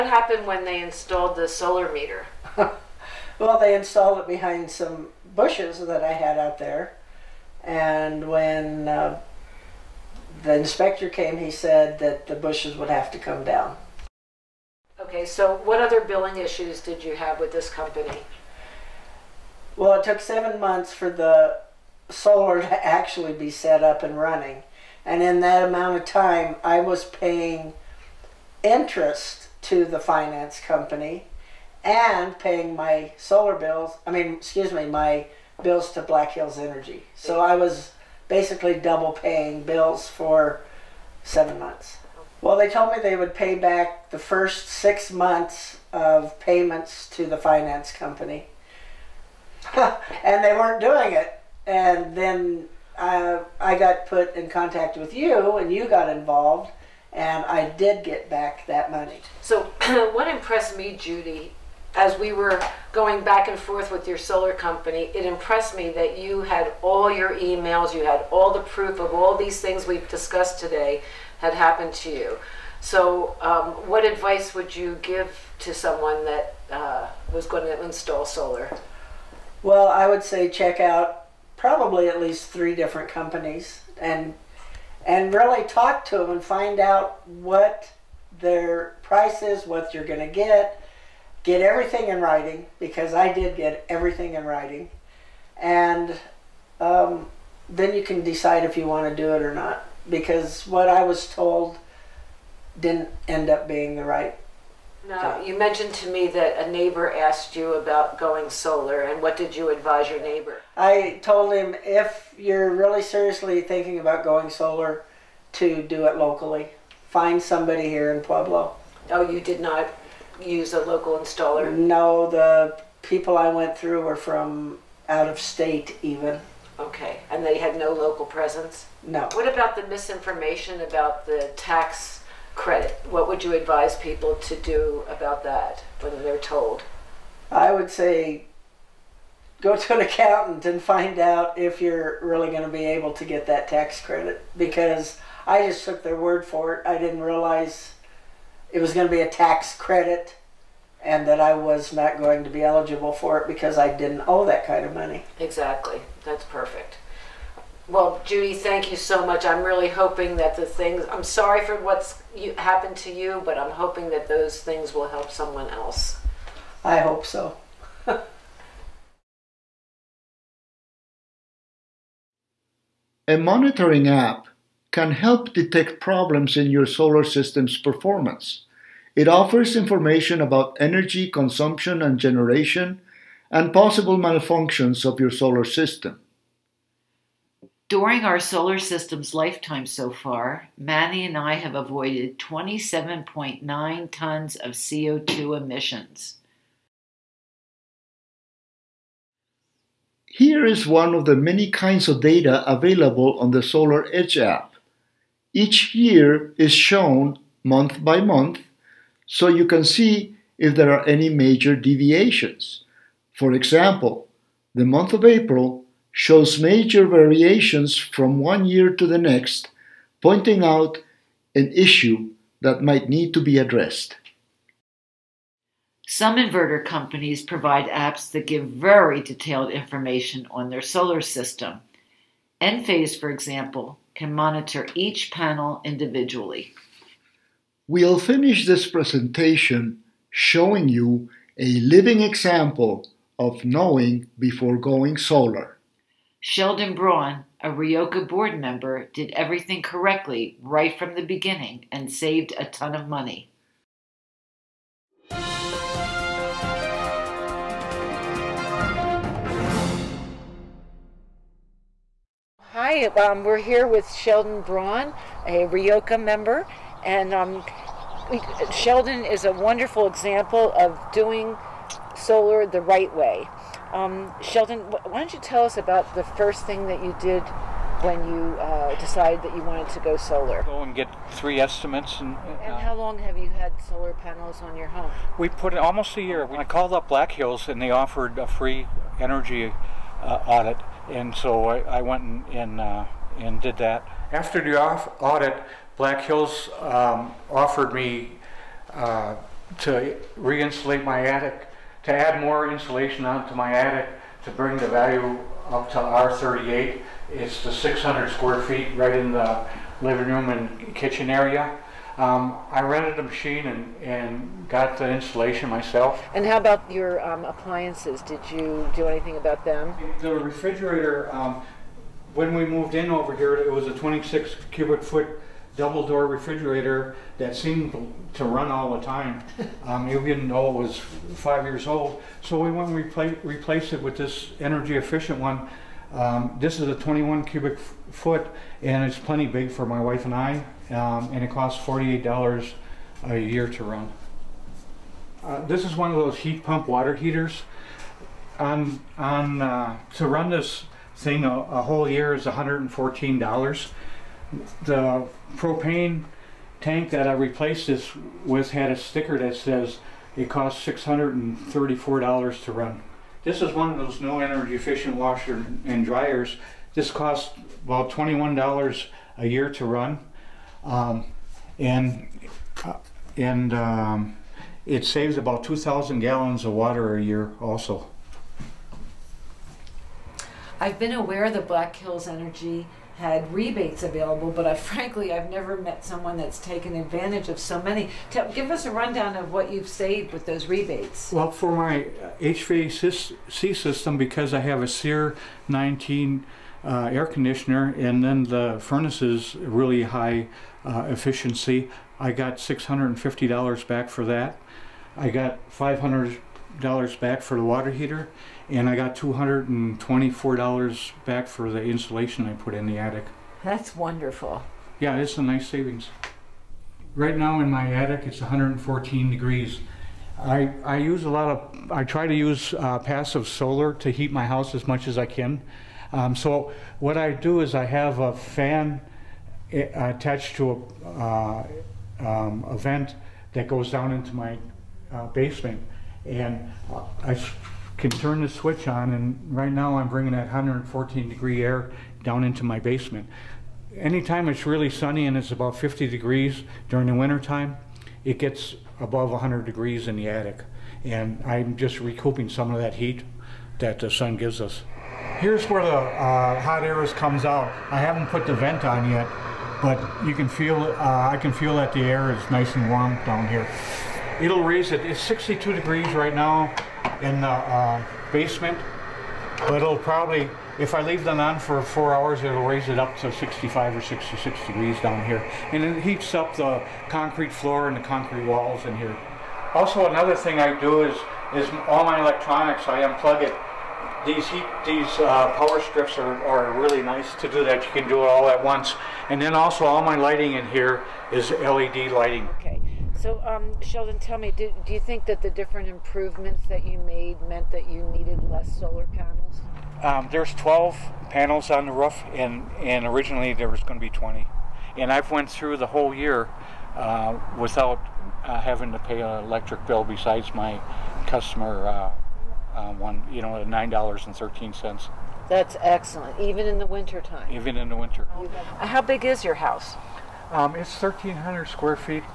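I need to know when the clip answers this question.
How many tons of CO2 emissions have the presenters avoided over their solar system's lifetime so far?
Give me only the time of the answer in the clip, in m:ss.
3:12.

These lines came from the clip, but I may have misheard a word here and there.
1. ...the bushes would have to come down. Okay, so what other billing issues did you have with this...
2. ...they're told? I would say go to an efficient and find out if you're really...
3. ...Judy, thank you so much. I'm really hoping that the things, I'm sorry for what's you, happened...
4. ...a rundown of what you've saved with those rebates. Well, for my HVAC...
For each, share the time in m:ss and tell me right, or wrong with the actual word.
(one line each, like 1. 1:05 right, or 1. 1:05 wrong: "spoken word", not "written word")
1. 0:12 right
2. 2:16 wrong: "accountant", not "efficient"
3. 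2:38 right
4. 6:28 right.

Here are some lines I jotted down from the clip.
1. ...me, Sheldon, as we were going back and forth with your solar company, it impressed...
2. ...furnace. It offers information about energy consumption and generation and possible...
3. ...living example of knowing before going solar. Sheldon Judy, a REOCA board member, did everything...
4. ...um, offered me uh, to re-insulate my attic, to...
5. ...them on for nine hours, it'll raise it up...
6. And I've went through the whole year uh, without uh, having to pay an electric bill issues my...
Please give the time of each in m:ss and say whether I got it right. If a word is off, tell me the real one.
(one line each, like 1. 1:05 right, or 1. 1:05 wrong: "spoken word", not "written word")
1. 1:00 wrong: "Judy", not "Sheldon"
2. 2:57 wrong: "performance", not "furnace"
3. 4:01 wrong: "Braun", not "Judy"
4. 4:56 right
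5. 7:51 wrong: "four", not "nine"
6. 8:24 wrong: "besides", not "issues".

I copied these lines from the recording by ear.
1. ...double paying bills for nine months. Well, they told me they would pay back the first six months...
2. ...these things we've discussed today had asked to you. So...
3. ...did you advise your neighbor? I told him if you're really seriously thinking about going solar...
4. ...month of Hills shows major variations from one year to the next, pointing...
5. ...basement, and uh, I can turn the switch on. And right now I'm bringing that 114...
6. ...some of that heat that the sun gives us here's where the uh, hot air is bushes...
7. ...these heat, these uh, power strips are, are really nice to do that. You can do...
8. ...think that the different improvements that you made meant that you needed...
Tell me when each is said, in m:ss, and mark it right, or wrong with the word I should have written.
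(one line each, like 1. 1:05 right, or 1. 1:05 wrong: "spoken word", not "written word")
1. 0:38 wrong: "seven", not "nine"
2. 1:09 wrong: "happened", not "asked"
3. 1:49 right
4. 3:34 wrong: "April", not "Hills"
5. 7:15 right
6. 7:32 wrong: "comes", not "bushes"
7. 8:04 right
8. 8:14 right.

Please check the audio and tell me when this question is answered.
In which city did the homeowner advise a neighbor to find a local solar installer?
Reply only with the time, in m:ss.
1:58.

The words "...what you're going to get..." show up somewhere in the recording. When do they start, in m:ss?
1:29.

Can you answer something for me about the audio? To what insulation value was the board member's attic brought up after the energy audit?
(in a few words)
R38.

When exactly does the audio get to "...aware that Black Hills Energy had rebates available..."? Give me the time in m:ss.
6:21.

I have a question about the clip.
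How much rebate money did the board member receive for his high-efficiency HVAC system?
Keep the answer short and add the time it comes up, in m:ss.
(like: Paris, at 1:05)
$650, at 6:42.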